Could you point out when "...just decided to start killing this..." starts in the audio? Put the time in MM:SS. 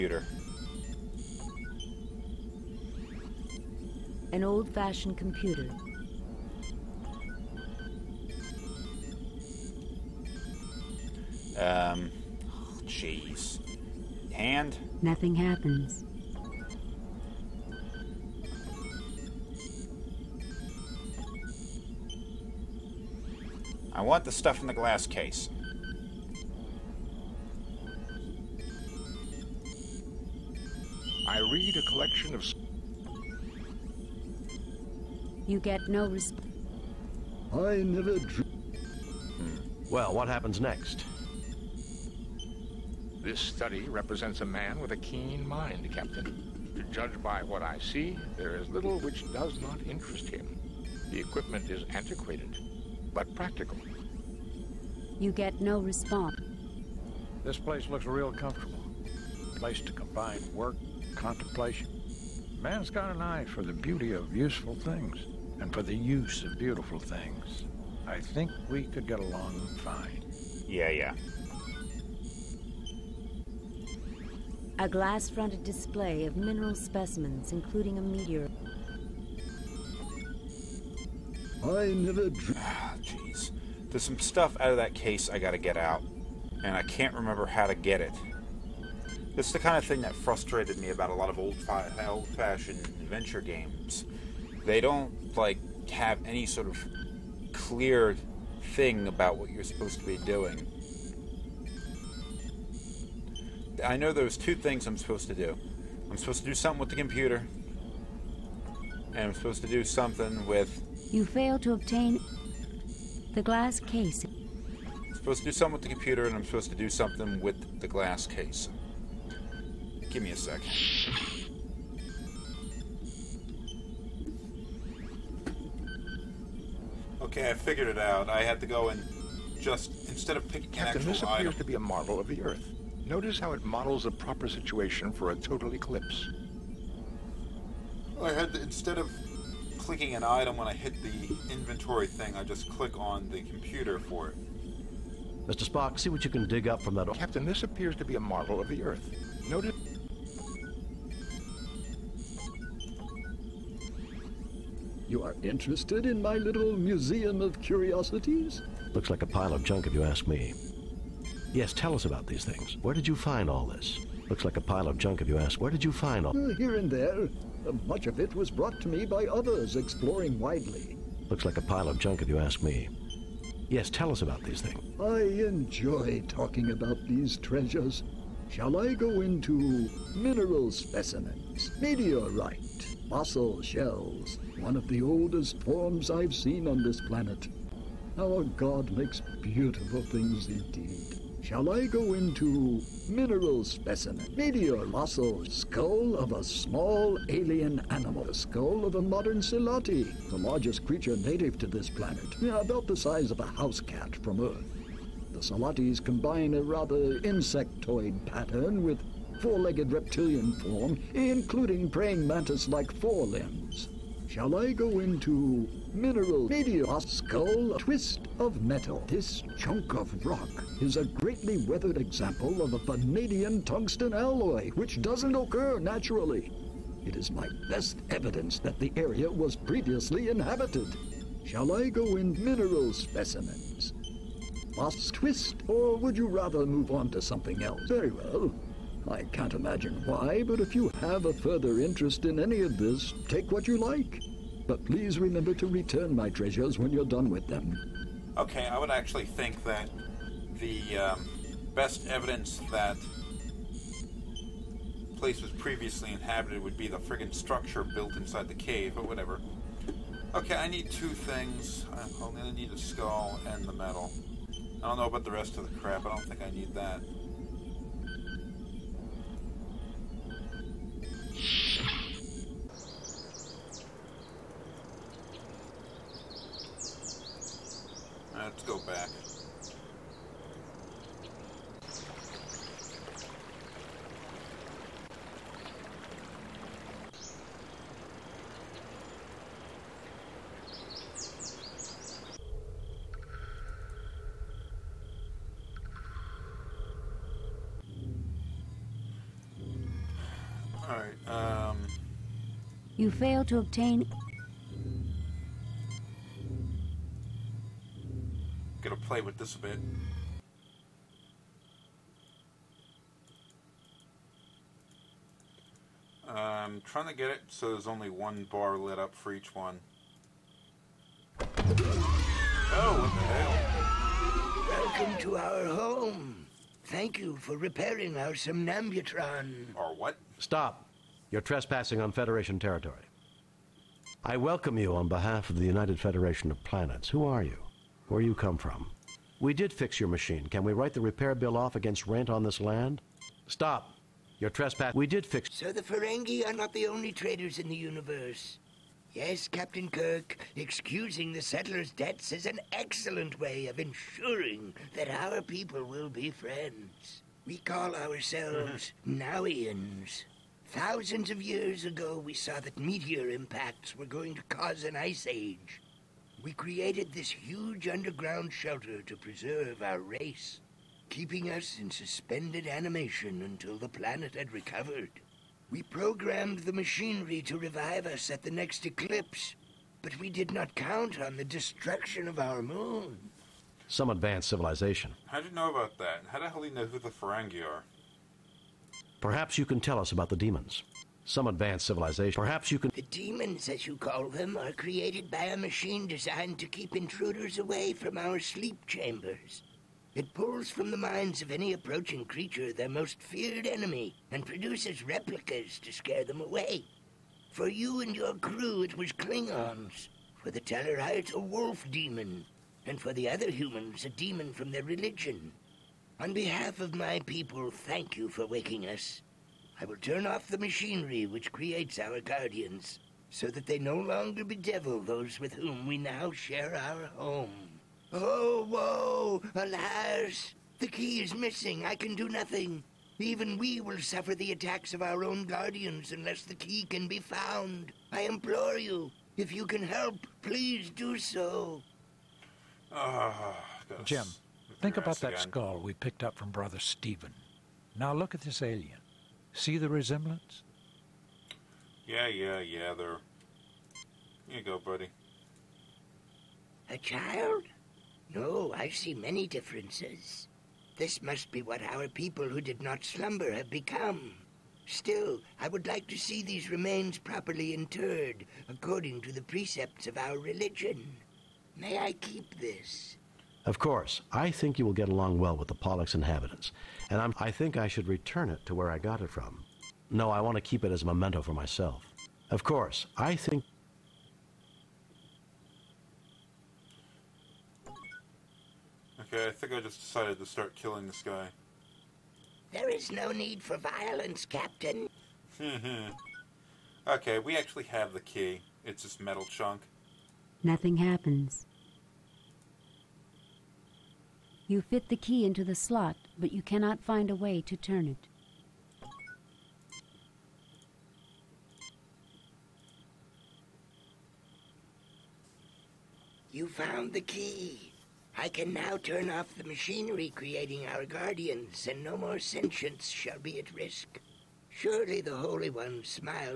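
08:09.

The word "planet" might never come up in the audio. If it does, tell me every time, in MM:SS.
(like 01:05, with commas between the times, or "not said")
03:07, 03:21, 05:36, 06:13.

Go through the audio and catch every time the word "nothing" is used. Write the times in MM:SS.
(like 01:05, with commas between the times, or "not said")
00:15, 07:12, 08:20.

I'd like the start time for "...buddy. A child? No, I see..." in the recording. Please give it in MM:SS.
07:34.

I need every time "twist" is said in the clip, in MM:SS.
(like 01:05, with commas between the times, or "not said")
03:37, 03:55.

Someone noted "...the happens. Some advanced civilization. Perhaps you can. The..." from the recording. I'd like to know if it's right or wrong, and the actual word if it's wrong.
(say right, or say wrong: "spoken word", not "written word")
wrong: "demons", not "happens".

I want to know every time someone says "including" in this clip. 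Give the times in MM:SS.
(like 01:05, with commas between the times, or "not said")
01:17, 03:31.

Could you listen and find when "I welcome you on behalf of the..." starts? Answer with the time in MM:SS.
05:34.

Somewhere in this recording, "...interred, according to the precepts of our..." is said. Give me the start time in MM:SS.
07:47.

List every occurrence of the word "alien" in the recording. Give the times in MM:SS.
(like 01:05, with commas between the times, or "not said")
03:17, 07:28.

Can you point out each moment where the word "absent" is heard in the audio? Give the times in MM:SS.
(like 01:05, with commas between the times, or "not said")
not said.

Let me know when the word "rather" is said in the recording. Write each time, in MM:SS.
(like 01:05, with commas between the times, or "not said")
03:26, 03:56.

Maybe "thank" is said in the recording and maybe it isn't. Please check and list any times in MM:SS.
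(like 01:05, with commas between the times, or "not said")
05:26, 06:57.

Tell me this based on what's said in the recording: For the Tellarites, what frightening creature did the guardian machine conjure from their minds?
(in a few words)
A wolf demon.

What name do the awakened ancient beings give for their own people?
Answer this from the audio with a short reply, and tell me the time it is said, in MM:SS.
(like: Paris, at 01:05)
Nauians, at 05:59.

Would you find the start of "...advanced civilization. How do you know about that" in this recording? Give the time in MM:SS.
06:24.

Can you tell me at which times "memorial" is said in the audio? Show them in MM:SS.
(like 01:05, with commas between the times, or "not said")
not said.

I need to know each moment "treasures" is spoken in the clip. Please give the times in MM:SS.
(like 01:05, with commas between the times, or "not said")
02:57, 04:06.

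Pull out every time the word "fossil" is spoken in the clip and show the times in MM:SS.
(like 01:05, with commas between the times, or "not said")
03:03, 03:14.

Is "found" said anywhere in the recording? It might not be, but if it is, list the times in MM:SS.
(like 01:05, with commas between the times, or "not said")
07:17, 08:36.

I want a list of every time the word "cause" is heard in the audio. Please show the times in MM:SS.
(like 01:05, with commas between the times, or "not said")
06:04.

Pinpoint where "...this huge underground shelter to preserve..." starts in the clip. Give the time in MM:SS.
06:07.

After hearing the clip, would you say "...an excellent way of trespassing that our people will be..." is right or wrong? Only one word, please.
wrong.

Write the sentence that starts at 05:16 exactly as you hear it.
I'm trying to get it so there's only one bar lit up for each one.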